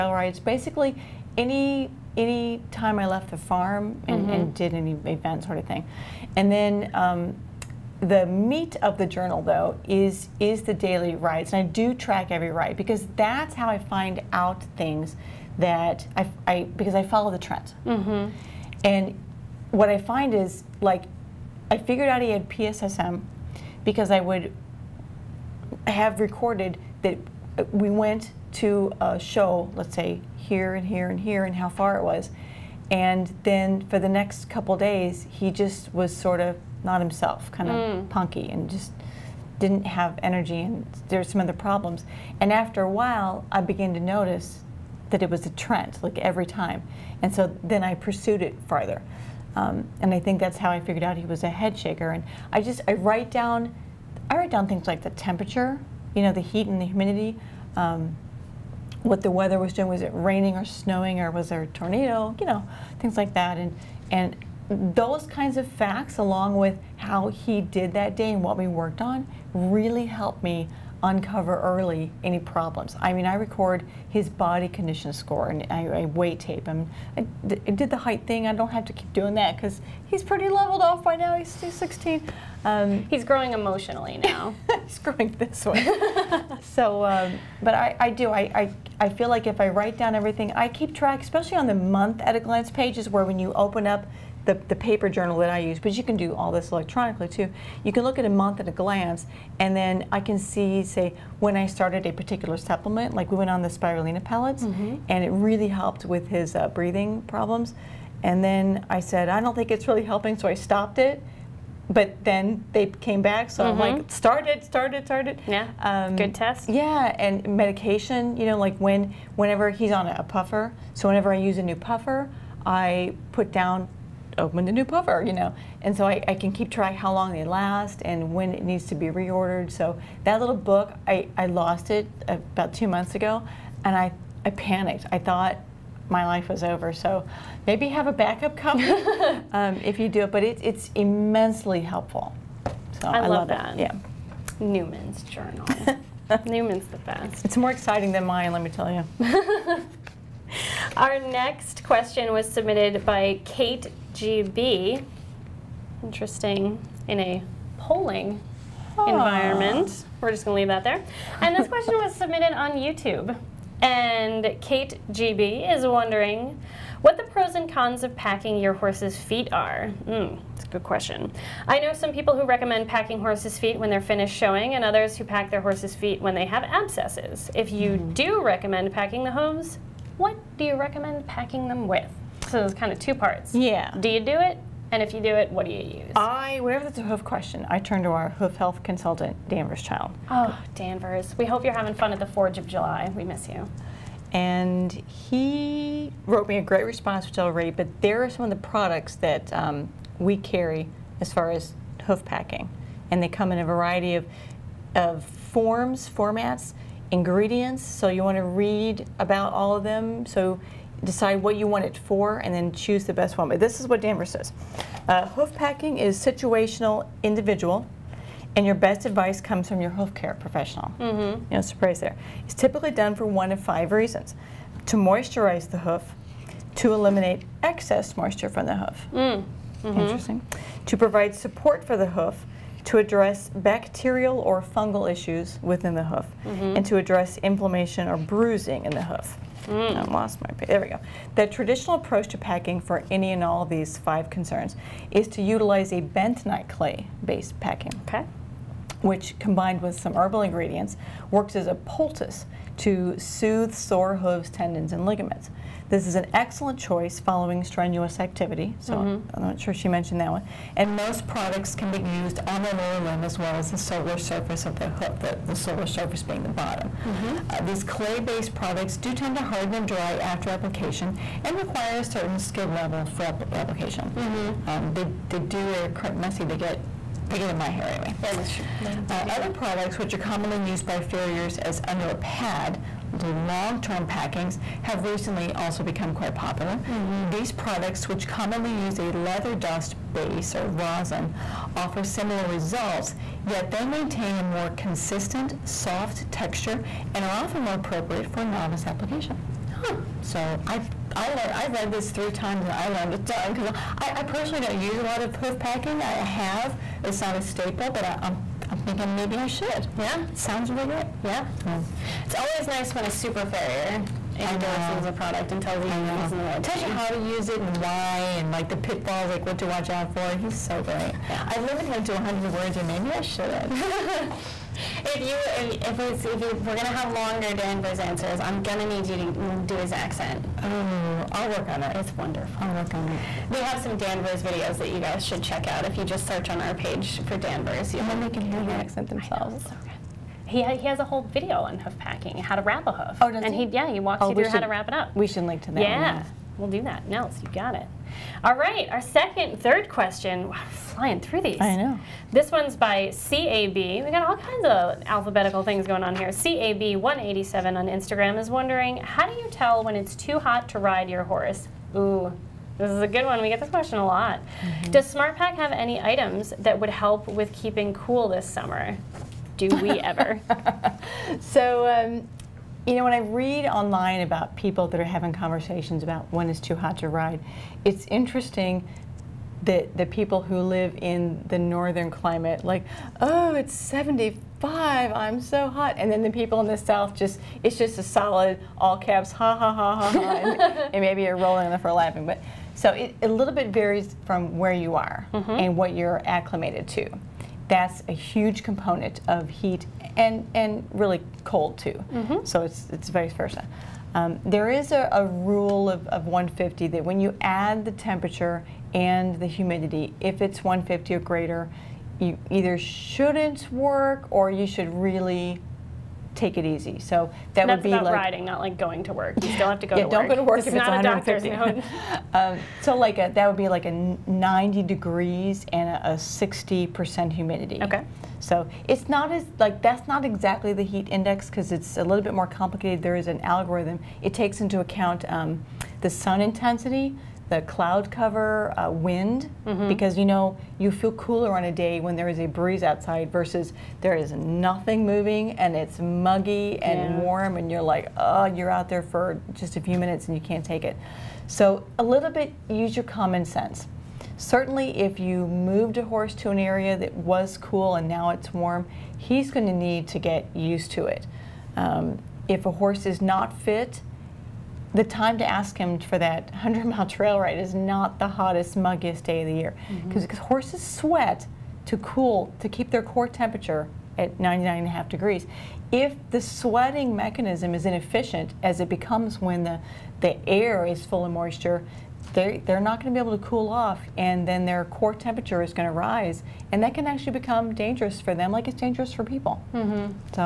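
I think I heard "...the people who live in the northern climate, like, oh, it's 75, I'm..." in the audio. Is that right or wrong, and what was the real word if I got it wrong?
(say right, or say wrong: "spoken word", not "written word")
right.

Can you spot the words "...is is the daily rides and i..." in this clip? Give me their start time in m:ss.
0:09.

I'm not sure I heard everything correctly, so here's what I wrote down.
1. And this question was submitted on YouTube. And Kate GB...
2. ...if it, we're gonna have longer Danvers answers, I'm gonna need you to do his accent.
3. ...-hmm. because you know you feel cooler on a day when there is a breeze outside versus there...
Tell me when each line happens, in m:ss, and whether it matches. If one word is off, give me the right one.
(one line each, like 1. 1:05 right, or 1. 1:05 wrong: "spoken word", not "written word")
1. 2:41 right
2. 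5:26 right
3. 7:19 right.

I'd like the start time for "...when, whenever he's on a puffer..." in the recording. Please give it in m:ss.
1:58.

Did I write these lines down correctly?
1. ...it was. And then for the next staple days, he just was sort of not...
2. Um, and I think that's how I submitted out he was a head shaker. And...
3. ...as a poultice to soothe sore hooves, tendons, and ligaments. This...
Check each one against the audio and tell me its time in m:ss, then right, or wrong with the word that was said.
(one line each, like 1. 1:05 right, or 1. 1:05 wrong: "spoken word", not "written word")
1. 0:31 wrong: "couple", not "staple"
2. 0:49 wrong: "figured", not "submitted"
3. 4:11 right.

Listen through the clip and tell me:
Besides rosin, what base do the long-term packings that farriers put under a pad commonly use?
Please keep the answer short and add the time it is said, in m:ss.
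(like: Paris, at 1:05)
leather dust, at 4:49.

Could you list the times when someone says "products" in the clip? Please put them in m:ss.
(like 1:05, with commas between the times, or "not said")
3:18, 4:21, 4:28, 4:39, 4:47, 5:15.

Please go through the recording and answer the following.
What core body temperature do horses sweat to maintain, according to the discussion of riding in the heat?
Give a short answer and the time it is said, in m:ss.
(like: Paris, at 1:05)
99.5 degrees, at 7:54.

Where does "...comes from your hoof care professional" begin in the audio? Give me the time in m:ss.
3:39.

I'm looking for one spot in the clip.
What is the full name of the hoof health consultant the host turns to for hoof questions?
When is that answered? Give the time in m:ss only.
3:09.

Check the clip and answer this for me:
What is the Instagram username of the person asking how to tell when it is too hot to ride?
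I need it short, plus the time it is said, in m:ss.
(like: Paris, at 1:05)
CAB187, at 5:56.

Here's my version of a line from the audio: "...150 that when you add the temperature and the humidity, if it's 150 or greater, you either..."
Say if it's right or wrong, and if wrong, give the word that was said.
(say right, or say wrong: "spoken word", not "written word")
right.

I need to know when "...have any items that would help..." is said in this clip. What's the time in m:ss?
6:05.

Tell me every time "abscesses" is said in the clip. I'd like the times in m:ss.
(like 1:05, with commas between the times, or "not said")
2:56.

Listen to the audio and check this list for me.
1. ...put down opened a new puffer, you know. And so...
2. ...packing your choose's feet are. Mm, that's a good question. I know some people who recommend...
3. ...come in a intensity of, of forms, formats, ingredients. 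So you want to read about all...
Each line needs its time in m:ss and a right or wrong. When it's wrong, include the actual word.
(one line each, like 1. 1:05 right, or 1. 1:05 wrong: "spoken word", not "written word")
1. 2:03 right
2. 2:48 wrong: "horse", not "choose"
3. 3:23 wrong: "variety", not "intensity".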